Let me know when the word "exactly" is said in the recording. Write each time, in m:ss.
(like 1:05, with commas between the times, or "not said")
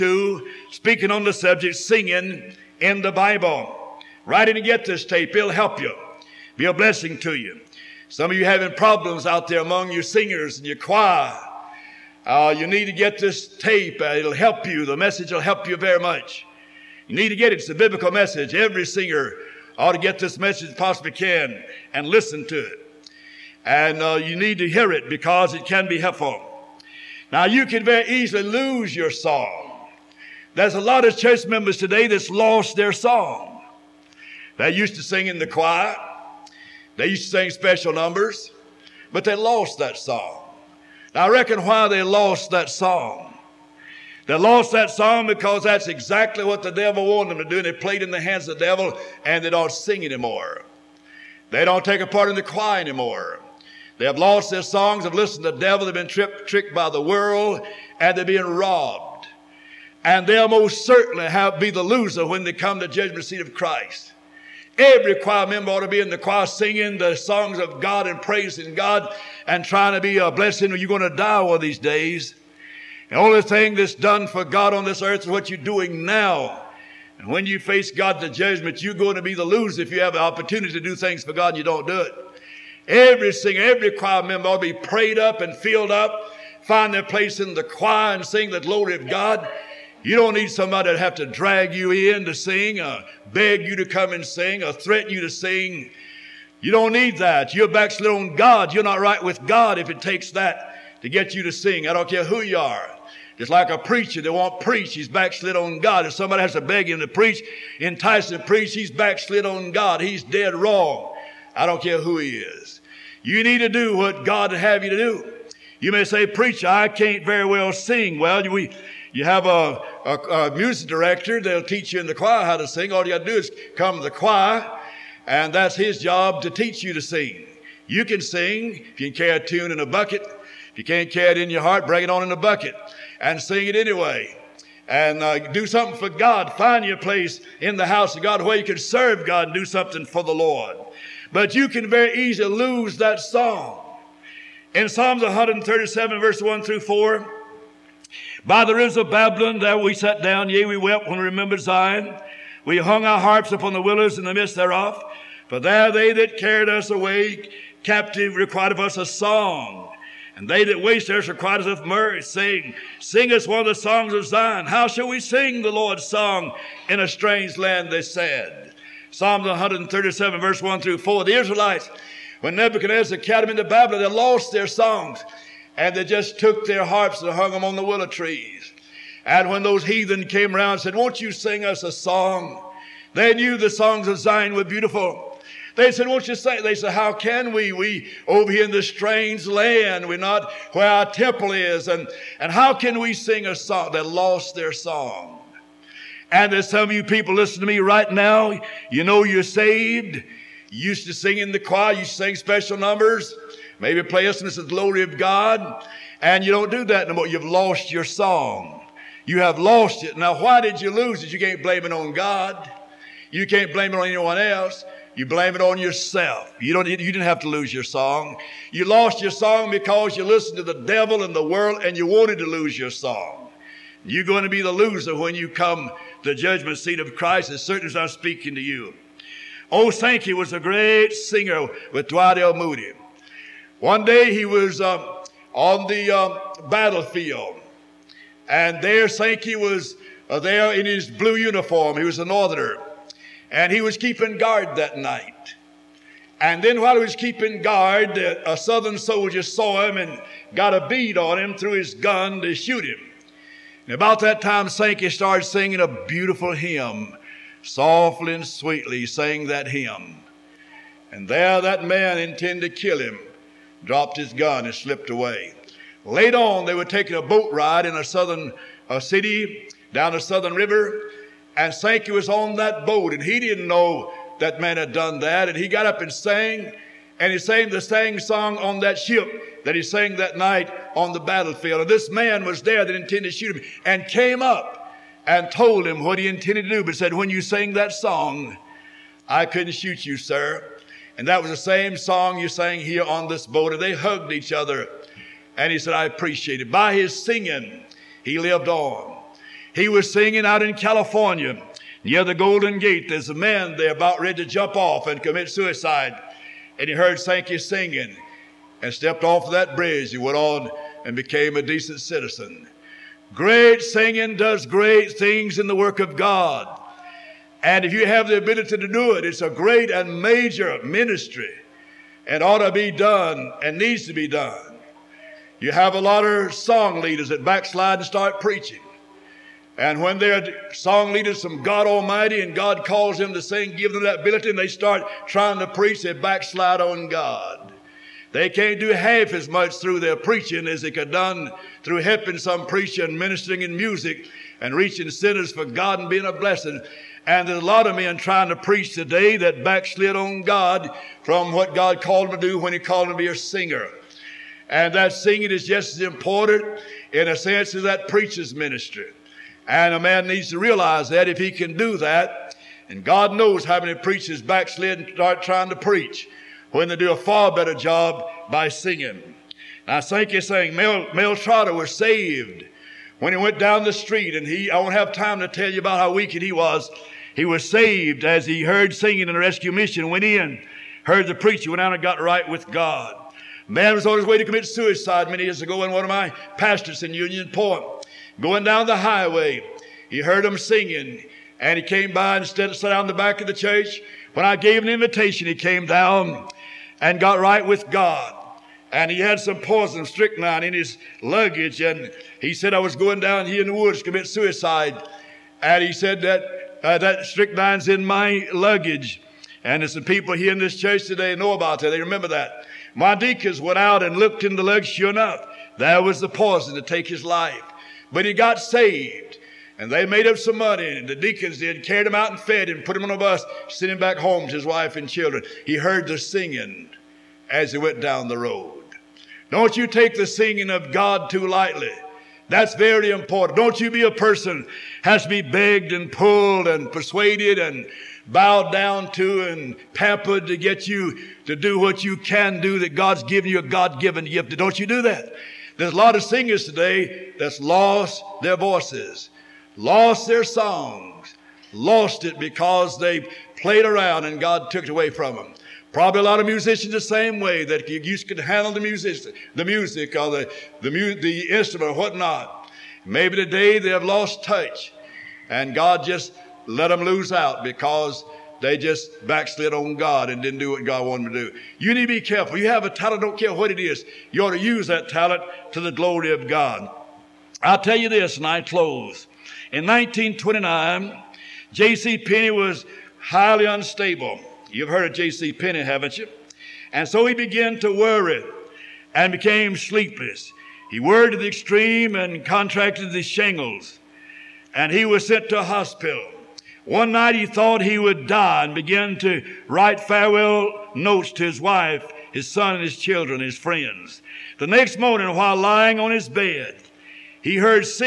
0:45.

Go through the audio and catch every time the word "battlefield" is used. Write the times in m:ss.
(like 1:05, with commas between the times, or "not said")
3:56, 4:41.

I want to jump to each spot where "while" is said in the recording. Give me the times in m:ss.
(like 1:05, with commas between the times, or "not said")
4:06, 8:25.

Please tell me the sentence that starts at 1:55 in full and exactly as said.
You may say, preacher, I can't very well sing.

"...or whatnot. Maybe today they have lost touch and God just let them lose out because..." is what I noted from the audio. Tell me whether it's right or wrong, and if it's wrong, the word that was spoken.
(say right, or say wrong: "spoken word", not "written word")
right.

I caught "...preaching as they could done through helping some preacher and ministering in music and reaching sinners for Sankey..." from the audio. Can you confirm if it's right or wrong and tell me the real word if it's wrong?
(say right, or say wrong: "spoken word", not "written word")
wrong: "God", not "Sankey".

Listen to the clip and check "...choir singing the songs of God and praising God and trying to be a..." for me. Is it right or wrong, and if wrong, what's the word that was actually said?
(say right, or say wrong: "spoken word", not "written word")
right.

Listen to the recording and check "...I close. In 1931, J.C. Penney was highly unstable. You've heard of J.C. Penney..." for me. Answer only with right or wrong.
wrong.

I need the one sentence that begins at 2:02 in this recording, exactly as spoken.
All you got to do is come to the choir, and that's his job to teach you to sing.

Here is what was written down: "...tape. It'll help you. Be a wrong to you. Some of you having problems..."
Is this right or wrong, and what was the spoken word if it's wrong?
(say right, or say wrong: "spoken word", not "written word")
wrong: "blessing", not "wrong".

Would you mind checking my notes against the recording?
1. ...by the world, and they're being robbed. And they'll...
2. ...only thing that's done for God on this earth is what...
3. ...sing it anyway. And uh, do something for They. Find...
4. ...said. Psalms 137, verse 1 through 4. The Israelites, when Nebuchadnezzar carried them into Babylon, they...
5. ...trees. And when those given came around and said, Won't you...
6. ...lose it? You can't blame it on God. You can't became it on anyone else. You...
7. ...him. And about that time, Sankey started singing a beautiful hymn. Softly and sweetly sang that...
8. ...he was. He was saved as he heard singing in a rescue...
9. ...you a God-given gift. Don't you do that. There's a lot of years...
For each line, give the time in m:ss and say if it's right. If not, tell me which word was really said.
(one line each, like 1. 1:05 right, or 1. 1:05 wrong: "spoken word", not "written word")
1. 0:56 right
2. 1:13 right
3. 2:13 wrong: "God", not "They"
4. 2:48 right
5. 2:58 wrong: "heathen", not "given"
6. 3:30 wrong: "blame", not "became"
7. 4:12 right
8. 6:16 right
9. 7:23 wrong: "singers", not "years".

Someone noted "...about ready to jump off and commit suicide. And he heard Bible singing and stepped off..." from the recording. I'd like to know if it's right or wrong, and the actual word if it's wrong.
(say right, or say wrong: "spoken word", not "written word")
wrong: "Sankey", not "Bible".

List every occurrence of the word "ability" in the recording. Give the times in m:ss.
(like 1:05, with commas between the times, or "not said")
5:18, 5:34.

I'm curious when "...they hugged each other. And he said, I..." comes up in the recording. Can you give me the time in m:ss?
4:53.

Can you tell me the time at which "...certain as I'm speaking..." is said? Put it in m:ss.
3:47.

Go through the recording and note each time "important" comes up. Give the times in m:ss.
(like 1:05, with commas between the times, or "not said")
5:56, 7:13.